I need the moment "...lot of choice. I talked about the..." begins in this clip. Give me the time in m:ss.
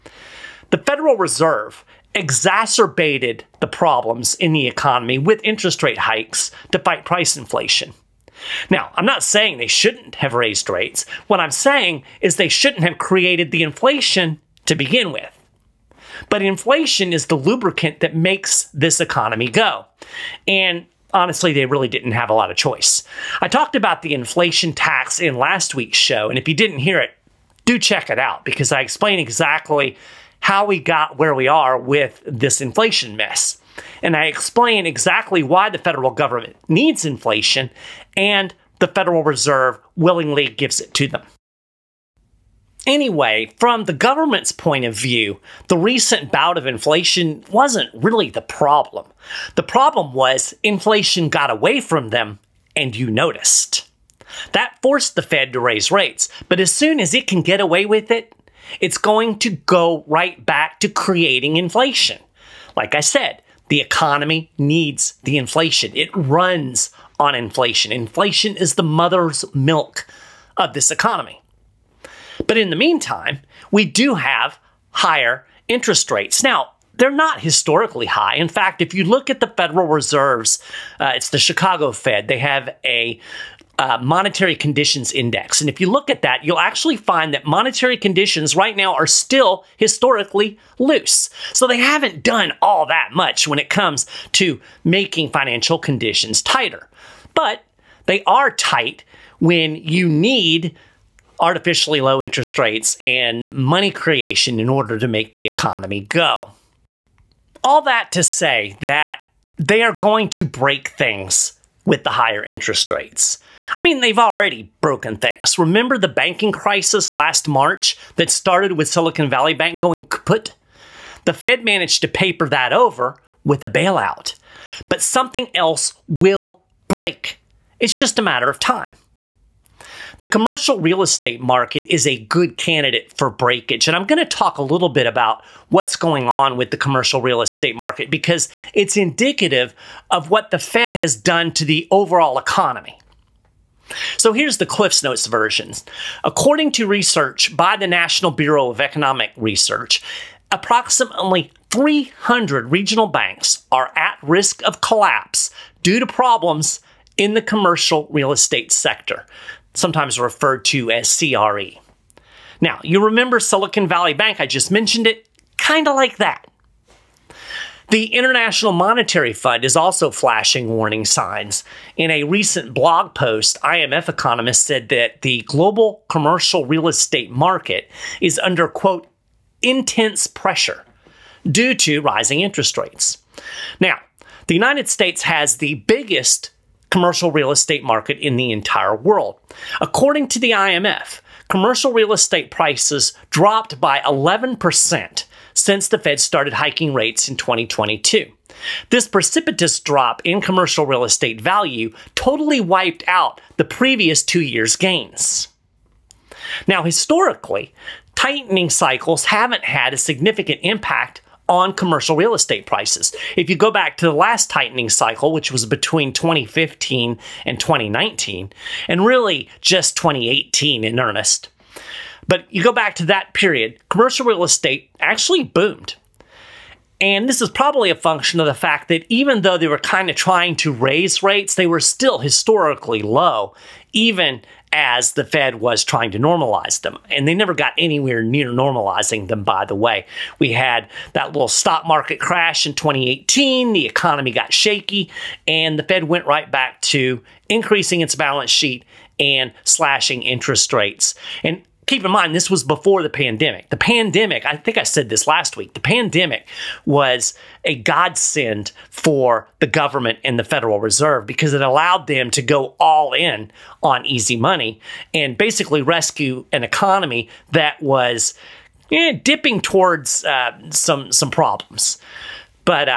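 0:22.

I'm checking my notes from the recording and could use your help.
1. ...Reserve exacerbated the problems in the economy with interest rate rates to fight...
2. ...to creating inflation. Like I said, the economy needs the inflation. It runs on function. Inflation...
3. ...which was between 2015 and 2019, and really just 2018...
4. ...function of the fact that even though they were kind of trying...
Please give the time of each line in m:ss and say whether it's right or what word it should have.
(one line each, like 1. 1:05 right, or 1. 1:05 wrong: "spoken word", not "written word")
1. 0:01 wrong: "hikes", not "rates"
2. 1:00 wrong: "inflation", not "function"
3. 3:35 right
4. 3:47 right.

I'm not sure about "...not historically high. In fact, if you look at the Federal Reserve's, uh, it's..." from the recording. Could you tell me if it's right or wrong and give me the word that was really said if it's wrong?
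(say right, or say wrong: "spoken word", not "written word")
right.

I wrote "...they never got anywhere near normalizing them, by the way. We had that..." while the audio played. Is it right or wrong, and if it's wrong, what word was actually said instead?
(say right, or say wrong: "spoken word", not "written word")
right.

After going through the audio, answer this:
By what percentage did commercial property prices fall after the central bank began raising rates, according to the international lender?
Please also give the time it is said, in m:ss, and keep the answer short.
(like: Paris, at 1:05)
11%, at 3:13.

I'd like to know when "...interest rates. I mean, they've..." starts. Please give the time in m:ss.
1:52.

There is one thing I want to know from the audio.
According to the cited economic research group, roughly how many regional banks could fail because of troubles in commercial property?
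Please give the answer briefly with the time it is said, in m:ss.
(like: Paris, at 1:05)
300, at 2:31.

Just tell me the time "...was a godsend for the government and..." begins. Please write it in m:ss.
4:16.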